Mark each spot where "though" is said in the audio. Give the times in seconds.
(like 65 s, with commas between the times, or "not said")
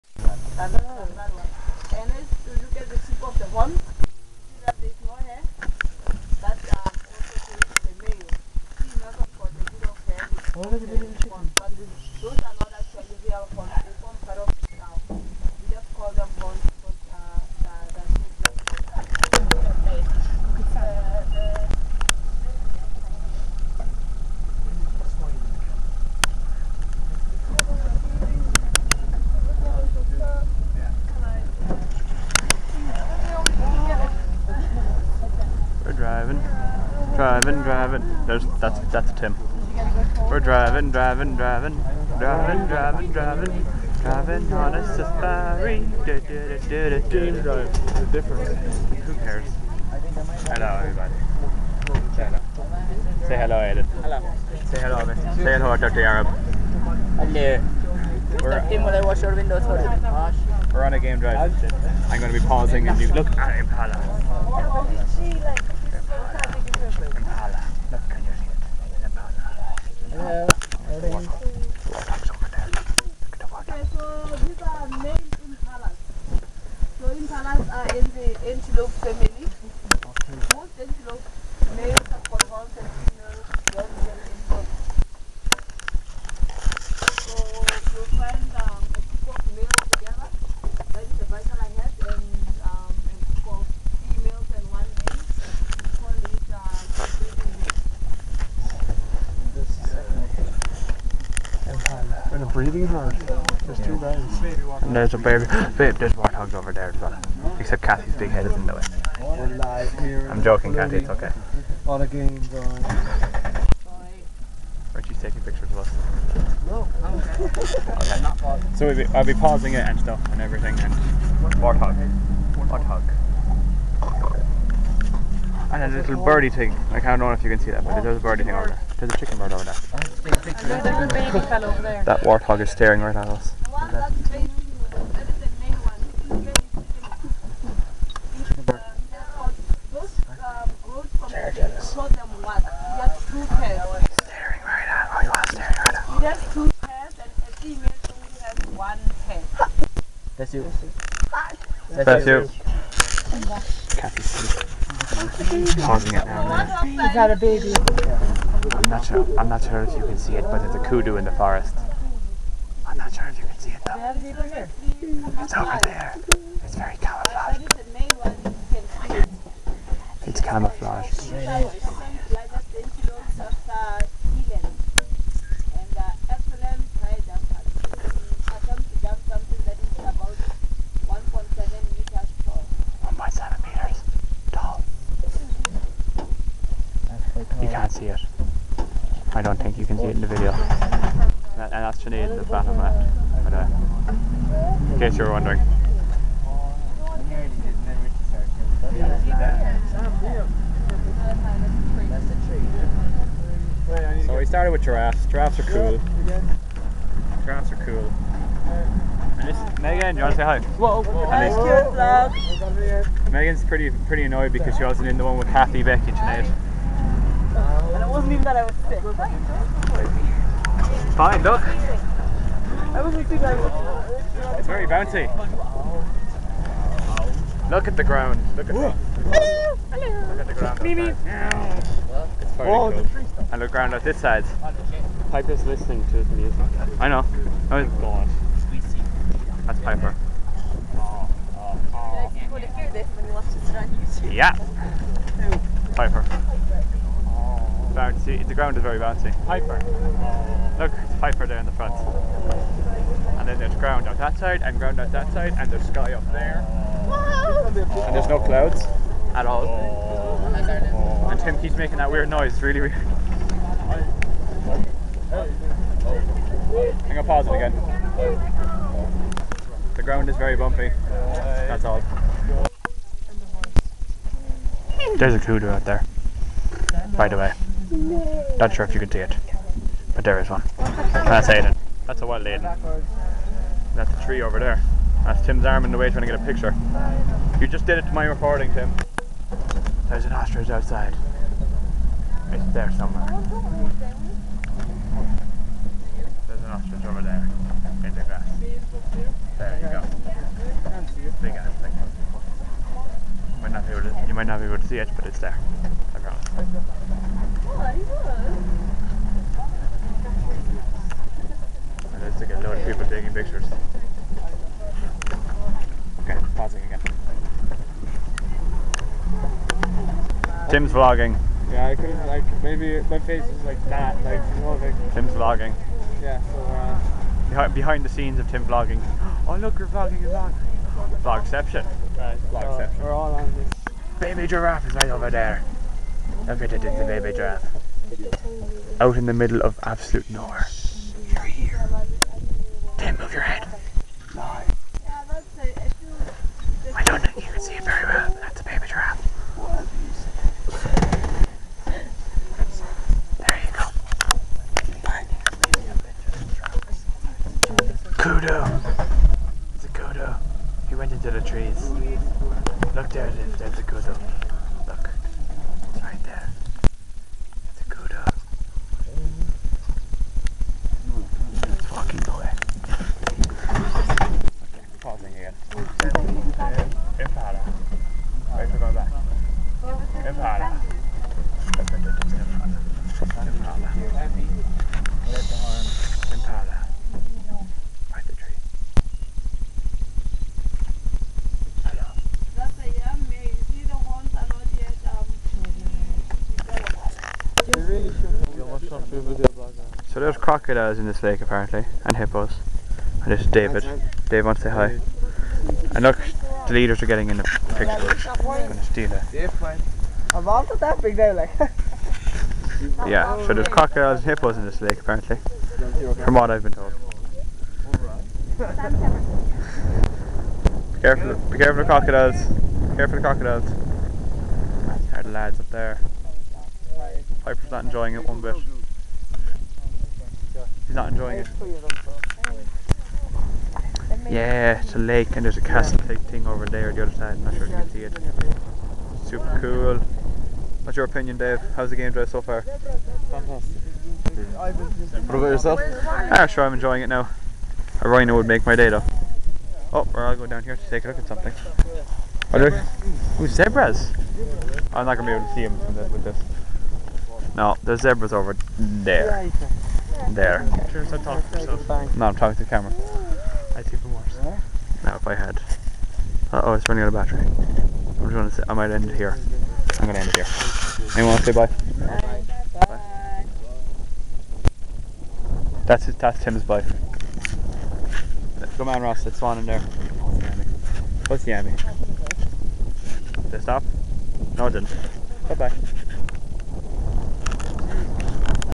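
163 s, 448 s.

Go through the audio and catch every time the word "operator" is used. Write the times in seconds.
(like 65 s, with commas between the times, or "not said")
not said.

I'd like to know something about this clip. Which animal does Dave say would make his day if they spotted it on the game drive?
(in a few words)
rhino.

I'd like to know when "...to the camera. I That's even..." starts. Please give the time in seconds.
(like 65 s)
462 s.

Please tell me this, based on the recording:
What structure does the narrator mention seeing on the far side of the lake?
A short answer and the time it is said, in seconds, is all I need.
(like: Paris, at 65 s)
castle, at 435 s.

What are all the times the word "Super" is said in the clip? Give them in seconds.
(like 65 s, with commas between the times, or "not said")
439 s.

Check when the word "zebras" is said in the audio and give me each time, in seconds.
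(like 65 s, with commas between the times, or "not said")
453 s, 458 s.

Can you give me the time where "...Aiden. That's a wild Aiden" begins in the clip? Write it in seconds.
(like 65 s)
281 s.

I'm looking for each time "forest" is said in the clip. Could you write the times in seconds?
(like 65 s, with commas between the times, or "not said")
161 s.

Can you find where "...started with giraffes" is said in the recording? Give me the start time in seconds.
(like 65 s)
204 s.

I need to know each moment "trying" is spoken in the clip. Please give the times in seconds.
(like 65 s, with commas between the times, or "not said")
286 s.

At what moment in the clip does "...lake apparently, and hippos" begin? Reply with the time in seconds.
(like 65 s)
401 s.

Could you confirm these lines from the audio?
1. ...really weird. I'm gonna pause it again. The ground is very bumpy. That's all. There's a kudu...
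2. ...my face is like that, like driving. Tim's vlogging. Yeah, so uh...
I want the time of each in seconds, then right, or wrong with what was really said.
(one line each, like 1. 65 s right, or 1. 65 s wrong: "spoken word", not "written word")
1. 262 s right
2. 323 s wrong: "moving", not "driving".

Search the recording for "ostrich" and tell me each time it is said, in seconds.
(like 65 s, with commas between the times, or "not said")
290 s, 296 s.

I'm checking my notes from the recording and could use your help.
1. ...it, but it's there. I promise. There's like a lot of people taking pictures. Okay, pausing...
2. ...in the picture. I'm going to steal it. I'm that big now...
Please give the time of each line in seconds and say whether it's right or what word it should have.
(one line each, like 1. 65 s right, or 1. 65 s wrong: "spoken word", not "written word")
1. 304 s right
2. 407 s right.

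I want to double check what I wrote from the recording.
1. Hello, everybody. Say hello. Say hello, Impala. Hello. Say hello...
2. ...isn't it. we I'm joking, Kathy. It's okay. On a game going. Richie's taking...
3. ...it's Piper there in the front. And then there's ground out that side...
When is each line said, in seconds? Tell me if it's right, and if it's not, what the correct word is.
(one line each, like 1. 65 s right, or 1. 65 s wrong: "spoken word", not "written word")
1. 50 s wrong: "Aiden", not "Impala"
2. 108 s right
3. 251 s right.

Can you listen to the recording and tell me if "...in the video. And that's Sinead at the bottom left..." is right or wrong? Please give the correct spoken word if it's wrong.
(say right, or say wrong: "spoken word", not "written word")
right.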